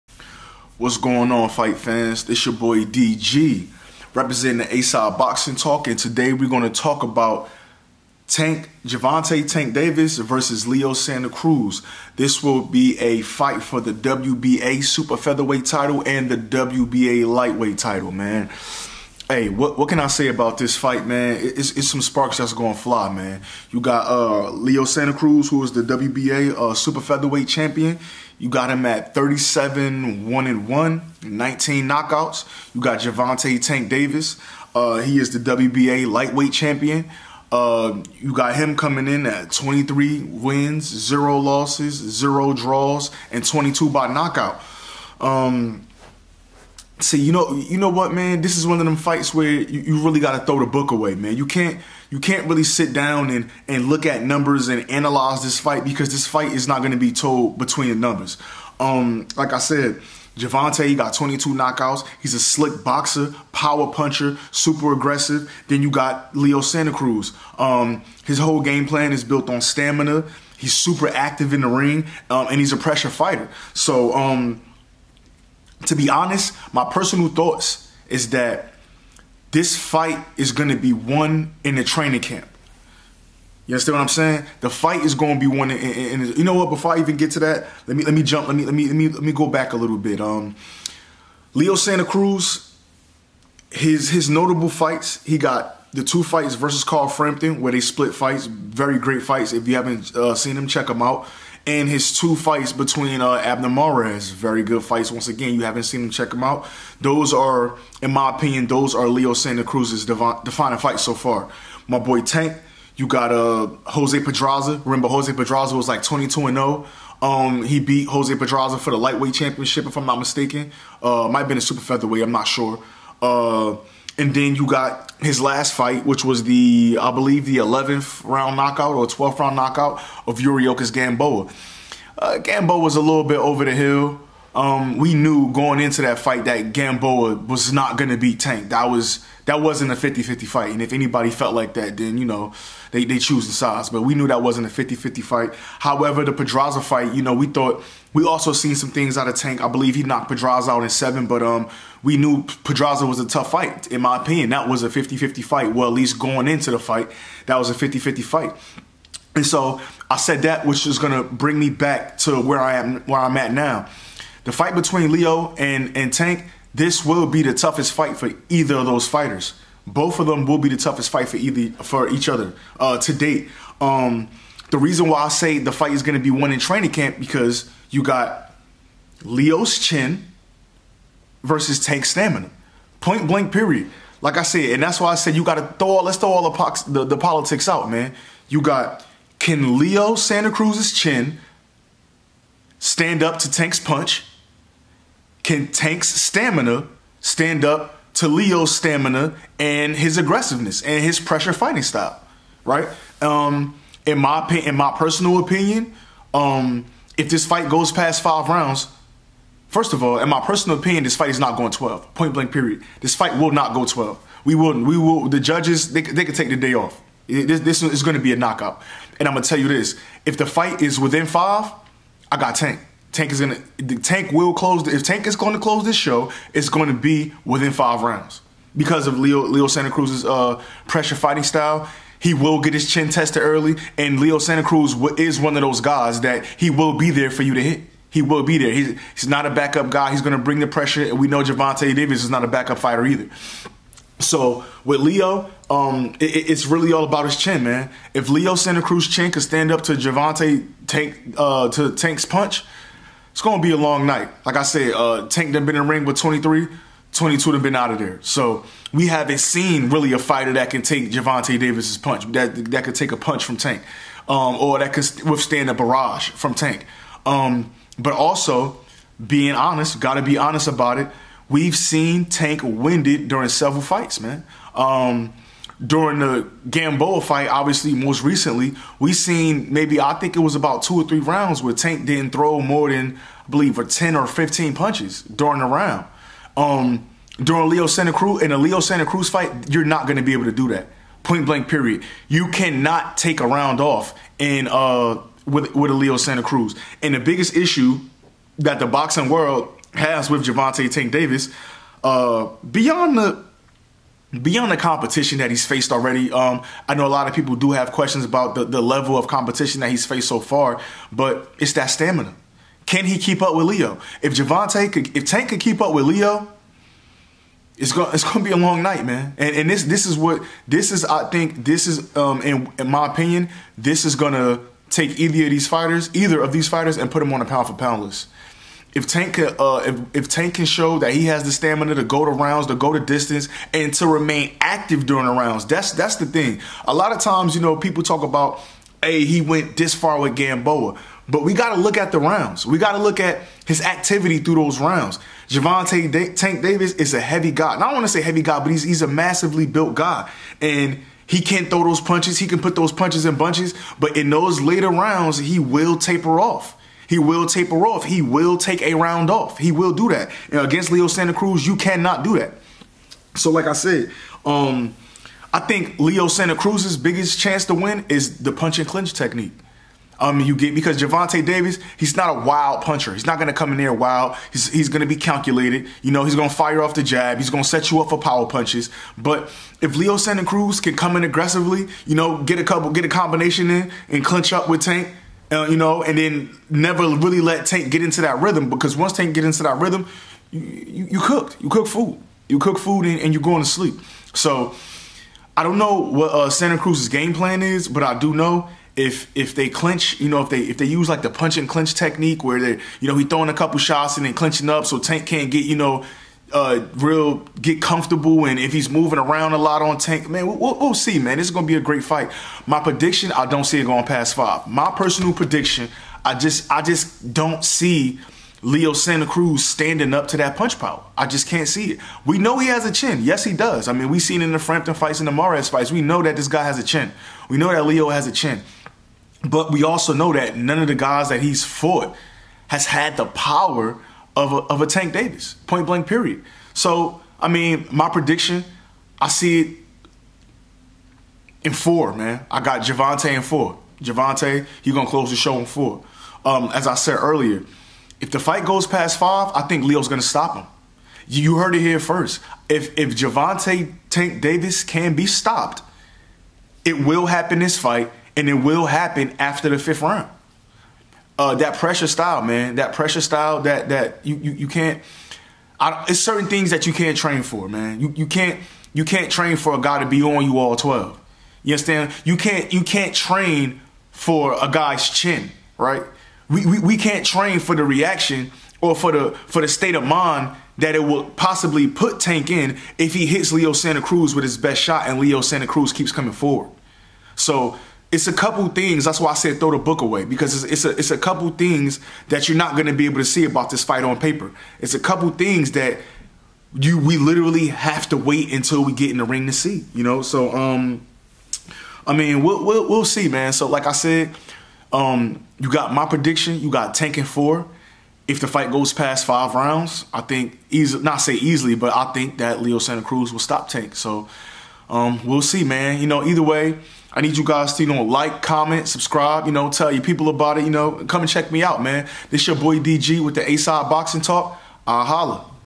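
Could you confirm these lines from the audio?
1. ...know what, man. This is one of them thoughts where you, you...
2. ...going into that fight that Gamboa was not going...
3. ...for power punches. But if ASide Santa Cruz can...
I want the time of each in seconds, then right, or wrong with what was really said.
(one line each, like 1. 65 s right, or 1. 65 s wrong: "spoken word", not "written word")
1. 47 s wrong: "fights", not "thoughts"
2. 135 s right
3. 378 s wrong: "Leo", not "ASide".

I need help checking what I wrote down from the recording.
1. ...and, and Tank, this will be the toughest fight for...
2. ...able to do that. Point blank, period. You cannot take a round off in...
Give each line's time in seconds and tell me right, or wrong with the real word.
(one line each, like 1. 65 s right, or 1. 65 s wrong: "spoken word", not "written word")
1. 165 s right
2. 290 s right.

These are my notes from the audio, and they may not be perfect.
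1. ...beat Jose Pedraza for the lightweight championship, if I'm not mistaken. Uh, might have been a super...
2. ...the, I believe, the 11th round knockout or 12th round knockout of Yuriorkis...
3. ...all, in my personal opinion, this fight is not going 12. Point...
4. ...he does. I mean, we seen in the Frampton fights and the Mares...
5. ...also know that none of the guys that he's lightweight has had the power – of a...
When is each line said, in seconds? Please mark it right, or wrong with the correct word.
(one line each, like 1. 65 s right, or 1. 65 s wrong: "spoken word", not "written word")
1. 117 s right
2. 126 s right
3. 210 s right
4. 423 s right
5. 429 s wrong: "fought", not "lightweight".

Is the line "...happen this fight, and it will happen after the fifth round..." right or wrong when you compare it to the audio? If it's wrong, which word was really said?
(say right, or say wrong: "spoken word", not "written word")
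right.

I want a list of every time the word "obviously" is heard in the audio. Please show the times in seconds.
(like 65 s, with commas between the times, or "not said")
277 s.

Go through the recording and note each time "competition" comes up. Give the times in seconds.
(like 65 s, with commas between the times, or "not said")
304 s, 309 s.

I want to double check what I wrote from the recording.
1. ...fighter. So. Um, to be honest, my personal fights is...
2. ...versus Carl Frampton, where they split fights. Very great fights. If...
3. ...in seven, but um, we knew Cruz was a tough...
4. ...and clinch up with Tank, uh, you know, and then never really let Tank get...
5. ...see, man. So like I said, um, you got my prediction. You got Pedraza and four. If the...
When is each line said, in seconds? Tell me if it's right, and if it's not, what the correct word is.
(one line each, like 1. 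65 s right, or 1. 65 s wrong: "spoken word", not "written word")
1. 73 s wrong: "thoughts", not "fights"
2. 96 s right
3. 150 s wrong: "Pedraza", not "Cruz"
4. 384 s right
5. 503 s wrong: "Tank", not "Pedraza".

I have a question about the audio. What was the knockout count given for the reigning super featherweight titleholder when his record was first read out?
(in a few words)
19.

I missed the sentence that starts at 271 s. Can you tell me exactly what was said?
We've seen Tank winded during several fights, man.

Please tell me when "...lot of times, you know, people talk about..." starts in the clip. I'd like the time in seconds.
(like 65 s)
336 s.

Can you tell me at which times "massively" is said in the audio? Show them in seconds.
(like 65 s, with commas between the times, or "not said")
349 s.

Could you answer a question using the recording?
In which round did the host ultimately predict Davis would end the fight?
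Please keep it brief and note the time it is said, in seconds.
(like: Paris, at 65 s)
4, at 442 s.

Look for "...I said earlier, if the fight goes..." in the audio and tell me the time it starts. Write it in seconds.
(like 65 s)
446 s.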